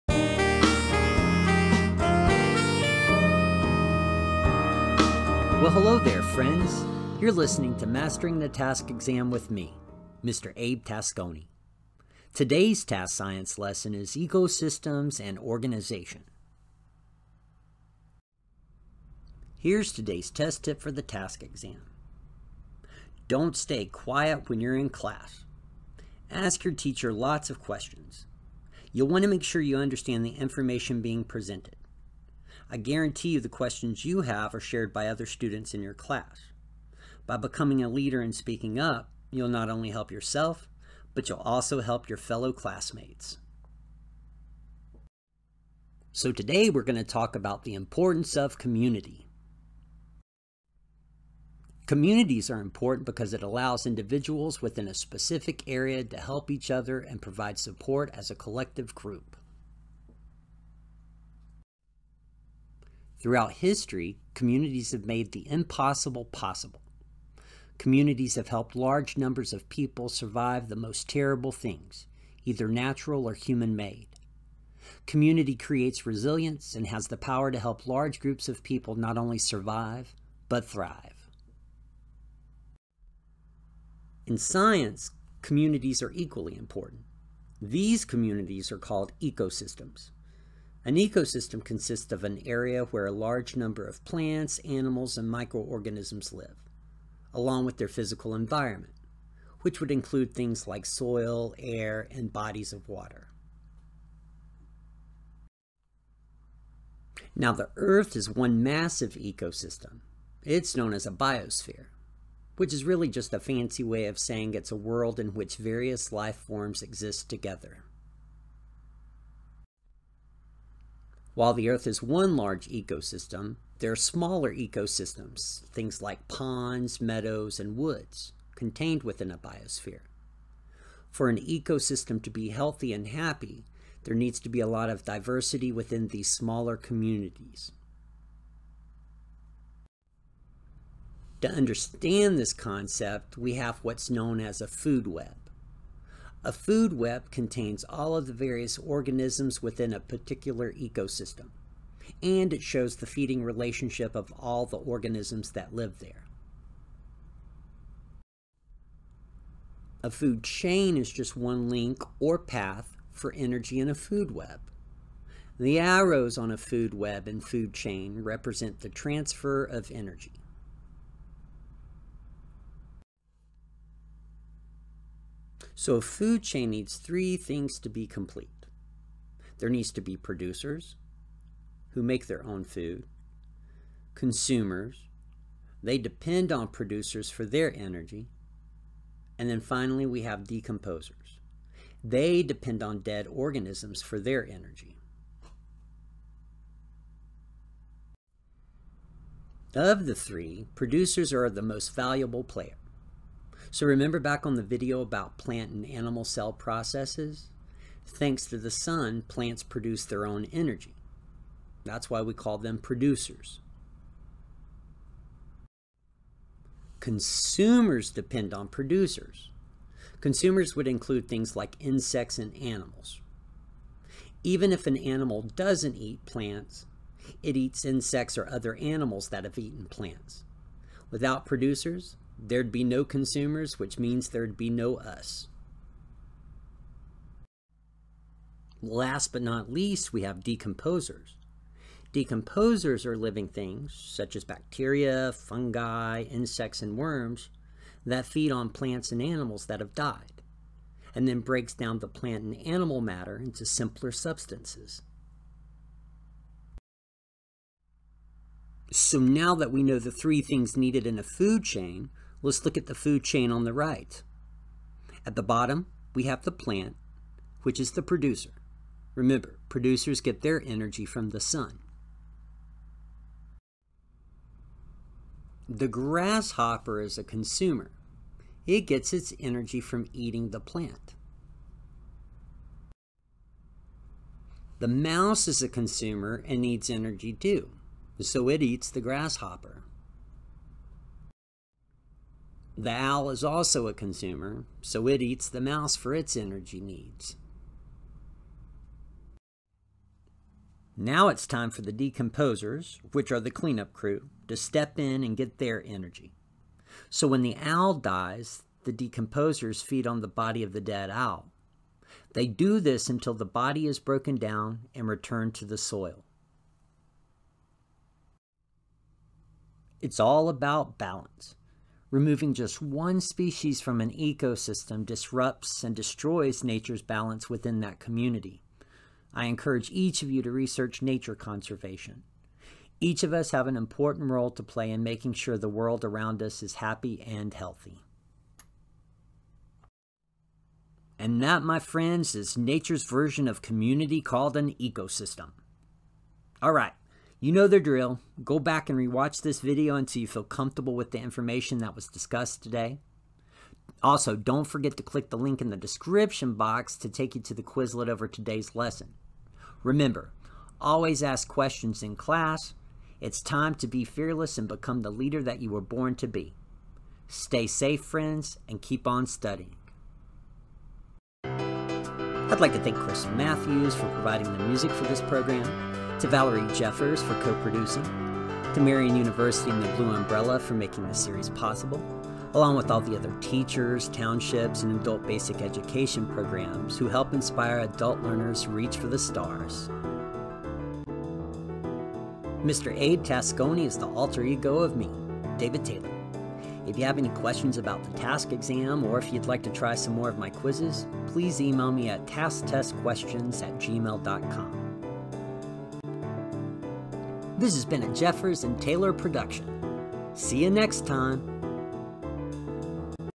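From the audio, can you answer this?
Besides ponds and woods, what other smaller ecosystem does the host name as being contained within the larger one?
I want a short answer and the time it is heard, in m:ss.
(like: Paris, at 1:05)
meadows, at 2:06.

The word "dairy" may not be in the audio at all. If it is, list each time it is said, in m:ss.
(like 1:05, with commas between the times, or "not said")
not said.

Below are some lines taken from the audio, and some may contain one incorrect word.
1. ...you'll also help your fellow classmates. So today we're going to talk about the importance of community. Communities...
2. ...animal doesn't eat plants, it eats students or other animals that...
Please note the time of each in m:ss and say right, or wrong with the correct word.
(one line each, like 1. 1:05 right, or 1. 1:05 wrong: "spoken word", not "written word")
1. 0:41 right
2. 3:44 wrong: "insects", not "students".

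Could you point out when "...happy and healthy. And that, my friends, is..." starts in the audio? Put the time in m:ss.
5:36.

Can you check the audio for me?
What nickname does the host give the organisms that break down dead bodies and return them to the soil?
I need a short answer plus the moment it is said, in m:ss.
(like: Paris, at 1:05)
the cleanup crew, at 5:03.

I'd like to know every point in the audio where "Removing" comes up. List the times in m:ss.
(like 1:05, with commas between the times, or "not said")
5:22.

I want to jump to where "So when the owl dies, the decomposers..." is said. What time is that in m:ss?
5:07.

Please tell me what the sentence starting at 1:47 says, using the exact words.
Now the Earth is one massive ecosystem.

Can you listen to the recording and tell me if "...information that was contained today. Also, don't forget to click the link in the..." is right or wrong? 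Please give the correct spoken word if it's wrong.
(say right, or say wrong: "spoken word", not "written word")
wrong: "discussed", not "contained".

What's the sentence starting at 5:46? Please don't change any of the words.
All right, you know the drill.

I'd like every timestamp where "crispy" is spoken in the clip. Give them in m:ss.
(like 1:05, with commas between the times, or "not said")
not said.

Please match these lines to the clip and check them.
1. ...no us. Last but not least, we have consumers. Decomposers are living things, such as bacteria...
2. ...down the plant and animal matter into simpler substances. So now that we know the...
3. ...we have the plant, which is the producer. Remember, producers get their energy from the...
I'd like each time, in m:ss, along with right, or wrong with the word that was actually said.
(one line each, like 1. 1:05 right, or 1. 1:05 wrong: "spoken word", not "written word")
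1. 3:54 wrong: "decomposers", not "consumers"
2. 4:11 right
3. 4:26 right.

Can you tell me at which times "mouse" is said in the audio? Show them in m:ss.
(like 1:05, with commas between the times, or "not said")
4:44, 4:55.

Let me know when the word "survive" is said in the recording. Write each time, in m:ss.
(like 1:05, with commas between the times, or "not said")
1:10, 1:19.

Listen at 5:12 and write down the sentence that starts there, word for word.
They do this until the body is broken down and returned to the soil.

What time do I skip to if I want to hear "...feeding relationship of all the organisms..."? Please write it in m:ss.
2:33.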